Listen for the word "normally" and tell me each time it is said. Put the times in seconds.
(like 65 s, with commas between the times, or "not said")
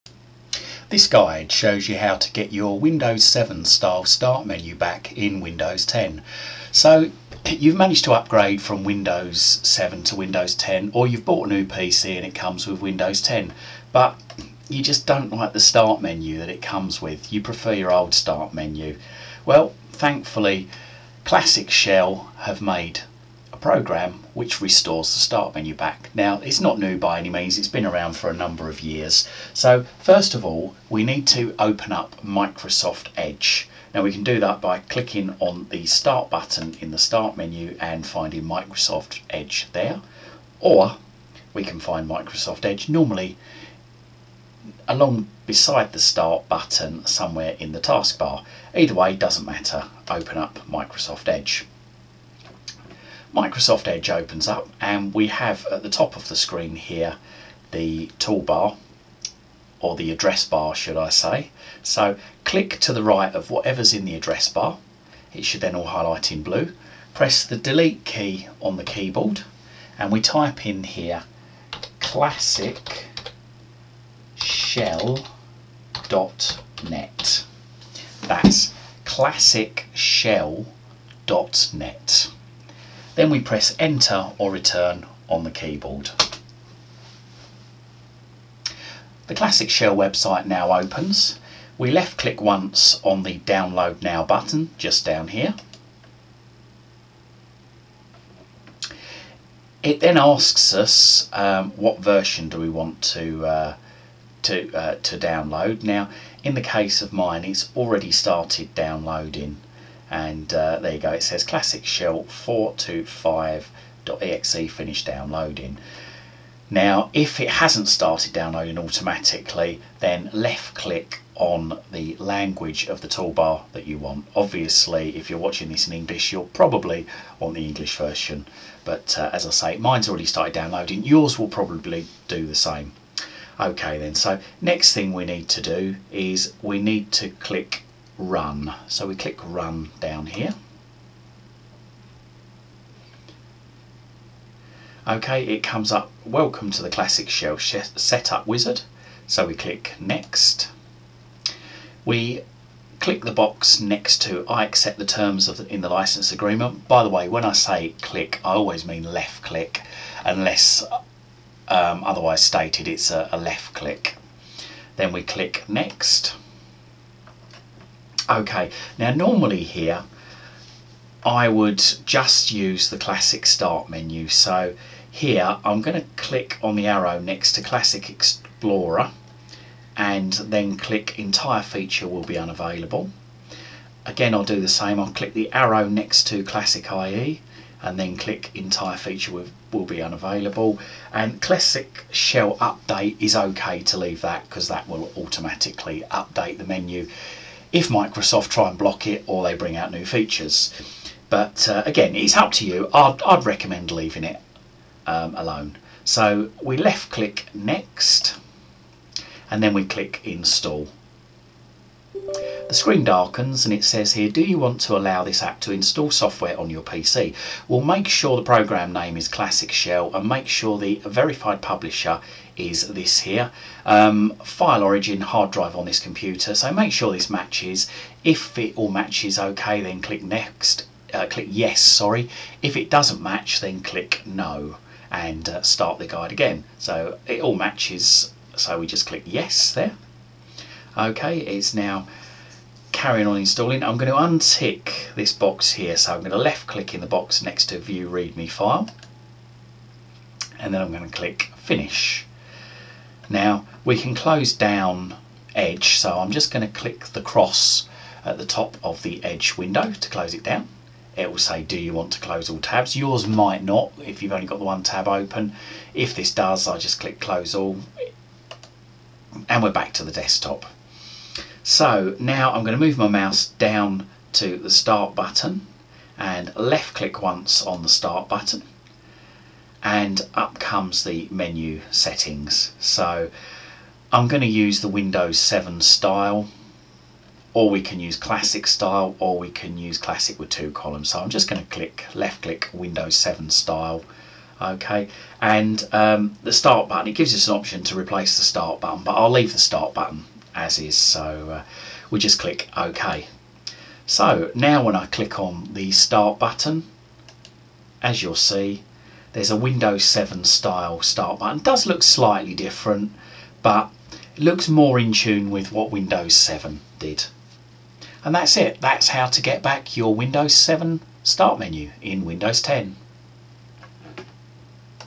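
42 s, 169 s.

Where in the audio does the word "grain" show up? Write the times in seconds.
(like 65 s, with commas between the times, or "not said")
not said.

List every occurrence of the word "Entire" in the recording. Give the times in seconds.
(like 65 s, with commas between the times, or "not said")
181 s, 188 s.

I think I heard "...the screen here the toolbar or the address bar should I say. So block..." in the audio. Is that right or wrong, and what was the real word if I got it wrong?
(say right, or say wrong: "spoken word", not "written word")
wrong: "click", not "block".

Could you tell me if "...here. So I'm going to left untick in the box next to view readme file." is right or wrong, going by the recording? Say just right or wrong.
wrong.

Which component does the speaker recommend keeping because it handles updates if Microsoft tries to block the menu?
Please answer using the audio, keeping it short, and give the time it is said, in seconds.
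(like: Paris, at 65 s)
Classic Shell Update, at 191 s.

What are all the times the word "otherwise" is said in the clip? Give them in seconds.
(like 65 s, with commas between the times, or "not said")
162 s.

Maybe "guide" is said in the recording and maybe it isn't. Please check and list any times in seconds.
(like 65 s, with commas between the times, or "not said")
1 s, 236 s.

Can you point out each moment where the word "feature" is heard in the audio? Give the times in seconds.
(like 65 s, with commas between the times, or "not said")
181 s, 188 s, 200 s.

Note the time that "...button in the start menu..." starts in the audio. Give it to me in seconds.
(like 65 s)
36 s.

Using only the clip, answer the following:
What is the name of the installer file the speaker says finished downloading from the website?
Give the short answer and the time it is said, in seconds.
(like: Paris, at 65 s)
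classic shell 425.exe, at 111 s.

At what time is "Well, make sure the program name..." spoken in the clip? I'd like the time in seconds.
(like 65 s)
217 s.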